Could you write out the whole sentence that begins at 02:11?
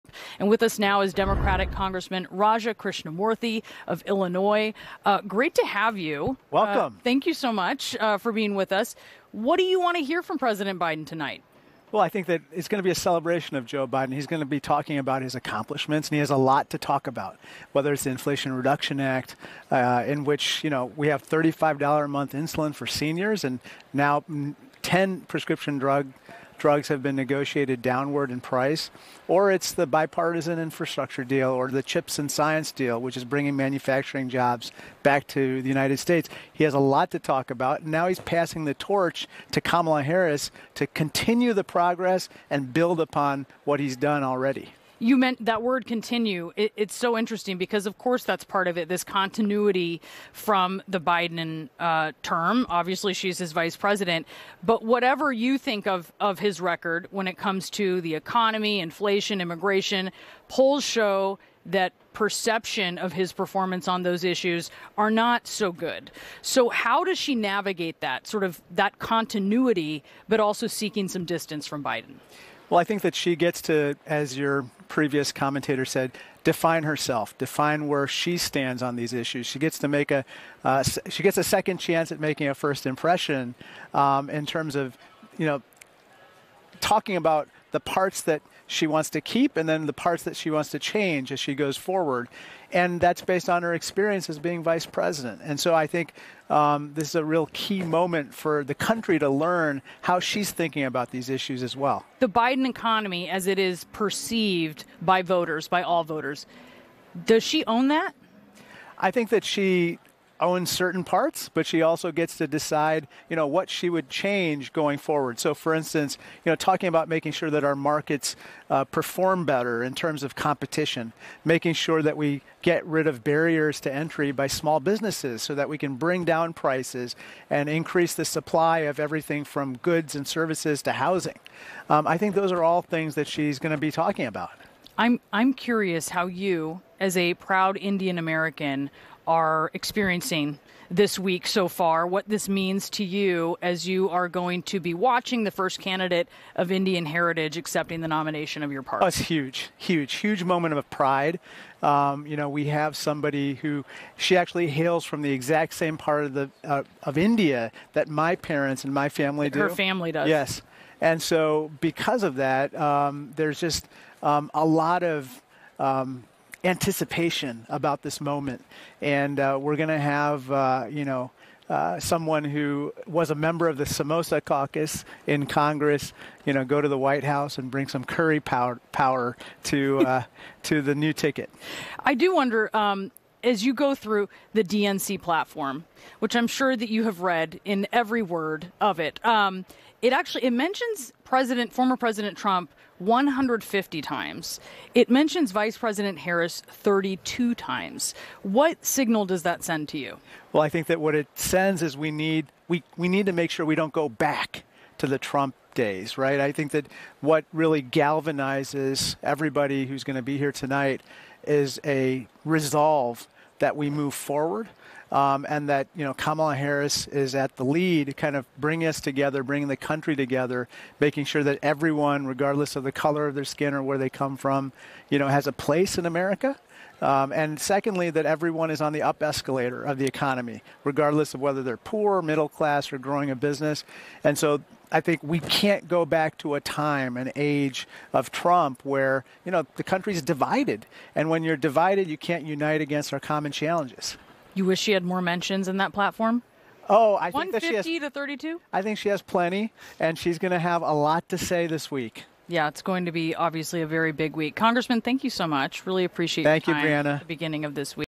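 Um, I think those are all things that she's going to be talking about.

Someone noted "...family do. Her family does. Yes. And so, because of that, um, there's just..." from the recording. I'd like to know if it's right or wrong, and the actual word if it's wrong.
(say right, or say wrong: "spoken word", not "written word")
right.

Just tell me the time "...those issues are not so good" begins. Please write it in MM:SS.
01:04.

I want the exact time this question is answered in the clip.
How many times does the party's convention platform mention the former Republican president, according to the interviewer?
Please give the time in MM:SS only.
03:12.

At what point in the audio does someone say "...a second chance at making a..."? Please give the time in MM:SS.
01:21.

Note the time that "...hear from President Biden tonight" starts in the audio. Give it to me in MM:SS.
00:10.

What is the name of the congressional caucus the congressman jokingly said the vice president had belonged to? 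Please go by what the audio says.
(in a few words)
Samosa Caucus.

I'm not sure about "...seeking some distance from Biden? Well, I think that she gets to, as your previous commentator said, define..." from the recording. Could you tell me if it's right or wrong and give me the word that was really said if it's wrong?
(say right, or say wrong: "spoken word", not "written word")
right.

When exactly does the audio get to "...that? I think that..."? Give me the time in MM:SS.
01:47.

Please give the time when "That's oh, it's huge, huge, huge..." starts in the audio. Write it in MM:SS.
02:29.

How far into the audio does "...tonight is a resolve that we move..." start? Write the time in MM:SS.
03:30.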